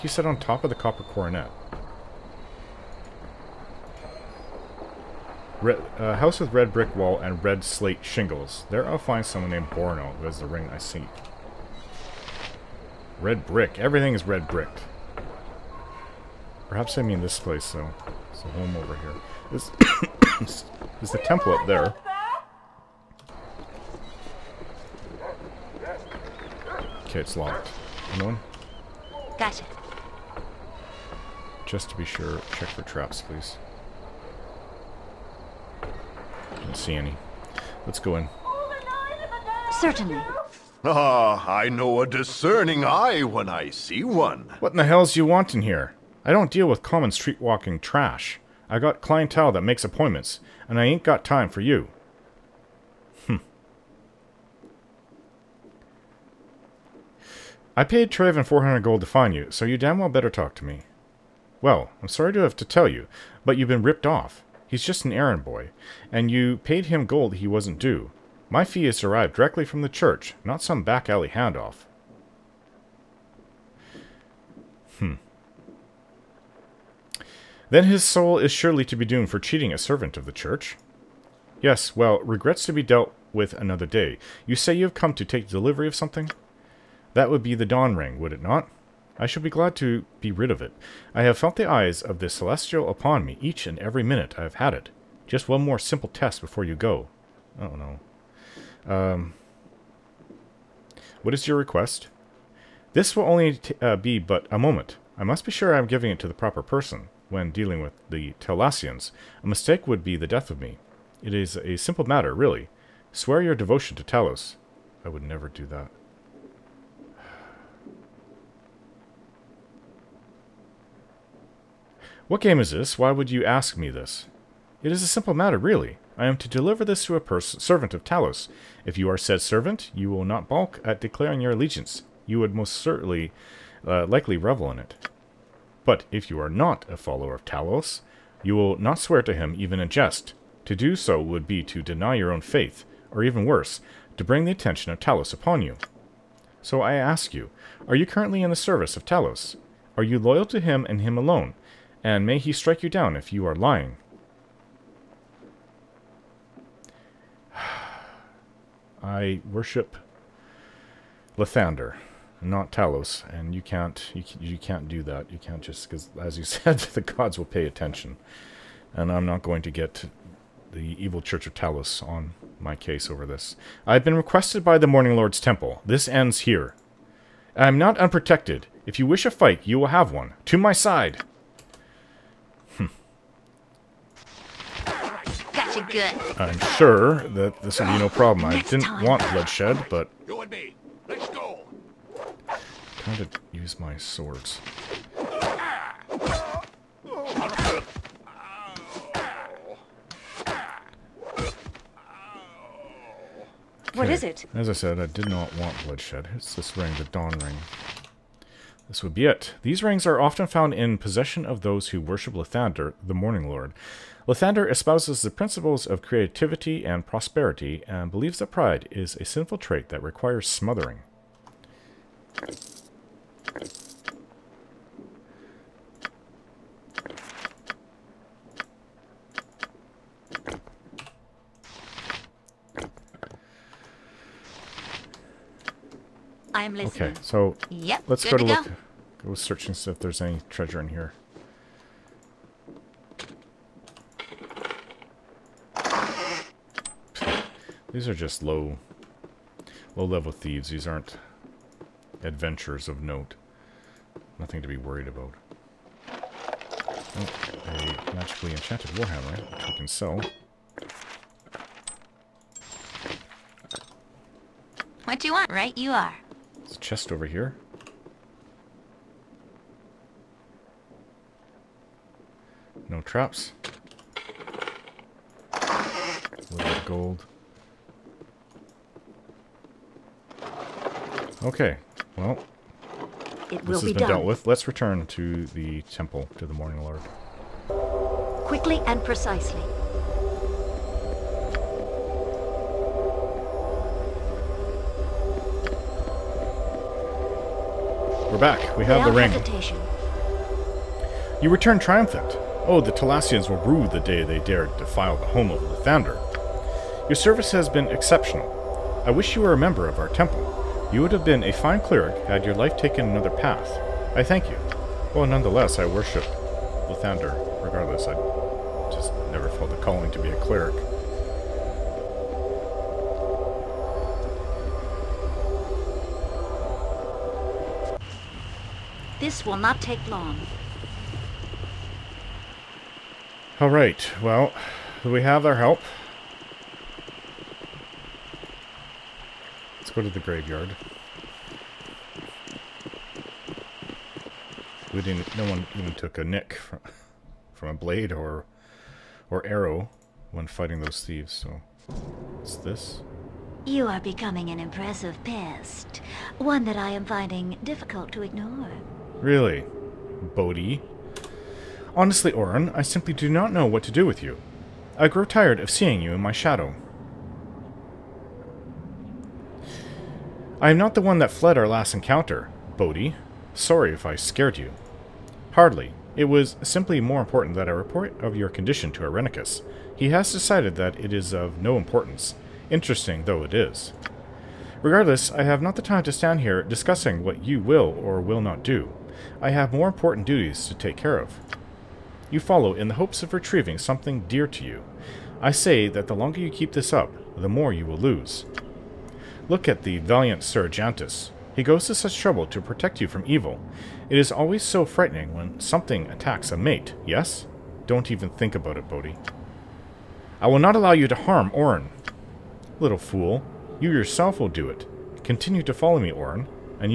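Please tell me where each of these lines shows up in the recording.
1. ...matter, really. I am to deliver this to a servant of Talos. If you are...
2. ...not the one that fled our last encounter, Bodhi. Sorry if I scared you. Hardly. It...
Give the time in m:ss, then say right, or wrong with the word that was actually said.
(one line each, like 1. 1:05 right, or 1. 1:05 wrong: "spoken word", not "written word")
1. 2:05 right
2. 6:10 right.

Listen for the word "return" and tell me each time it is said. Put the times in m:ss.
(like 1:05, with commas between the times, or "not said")
4:44, 5:01.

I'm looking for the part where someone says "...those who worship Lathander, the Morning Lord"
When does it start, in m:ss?
3:31.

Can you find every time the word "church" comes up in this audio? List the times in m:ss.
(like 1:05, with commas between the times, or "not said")
1:09, 1:20, 2:51.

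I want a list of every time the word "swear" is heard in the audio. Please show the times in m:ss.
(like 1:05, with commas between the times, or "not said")
1:53, 2:18.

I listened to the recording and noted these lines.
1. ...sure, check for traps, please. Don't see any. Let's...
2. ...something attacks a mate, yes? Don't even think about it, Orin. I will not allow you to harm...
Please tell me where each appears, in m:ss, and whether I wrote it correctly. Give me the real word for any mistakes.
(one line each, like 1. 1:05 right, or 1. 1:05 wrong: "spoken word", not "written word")
1. 0:32 right
2. 6:45 wrong: "Bodhi", not "Orin".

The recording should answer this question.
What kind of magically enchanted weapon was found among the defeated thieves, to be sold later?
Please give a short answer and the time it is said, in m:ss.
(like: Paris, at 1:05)
warhammer, at 4:18.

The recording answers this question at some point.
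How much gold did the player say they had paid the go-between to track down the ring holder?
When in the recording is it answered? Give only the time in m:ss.
0:58.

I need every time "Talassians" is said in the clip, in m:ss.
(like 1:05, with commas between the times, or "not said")
1:48, 5:02.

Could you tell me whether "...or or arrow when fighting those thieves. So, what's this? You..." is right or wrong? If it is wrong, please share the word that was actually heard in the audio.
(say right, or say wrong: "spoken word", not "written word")
right.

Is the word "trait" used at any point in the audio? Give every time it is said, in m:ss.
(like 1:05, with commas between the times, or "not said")
3:39.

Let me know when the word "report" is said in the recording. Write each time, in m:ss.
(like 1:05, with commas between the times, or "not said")
6:17.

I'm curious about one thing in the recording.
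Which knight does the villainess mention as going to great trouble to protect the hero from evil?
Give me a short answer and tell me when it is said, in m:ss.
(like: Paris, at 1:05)
Sir Ajantis, at 6:40.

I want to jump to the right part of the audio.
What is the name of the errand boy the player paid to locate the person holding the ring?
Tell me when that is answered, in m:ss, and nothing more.
0:58.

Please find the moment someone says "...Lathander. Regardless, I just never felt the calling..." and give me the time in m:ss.
5:16.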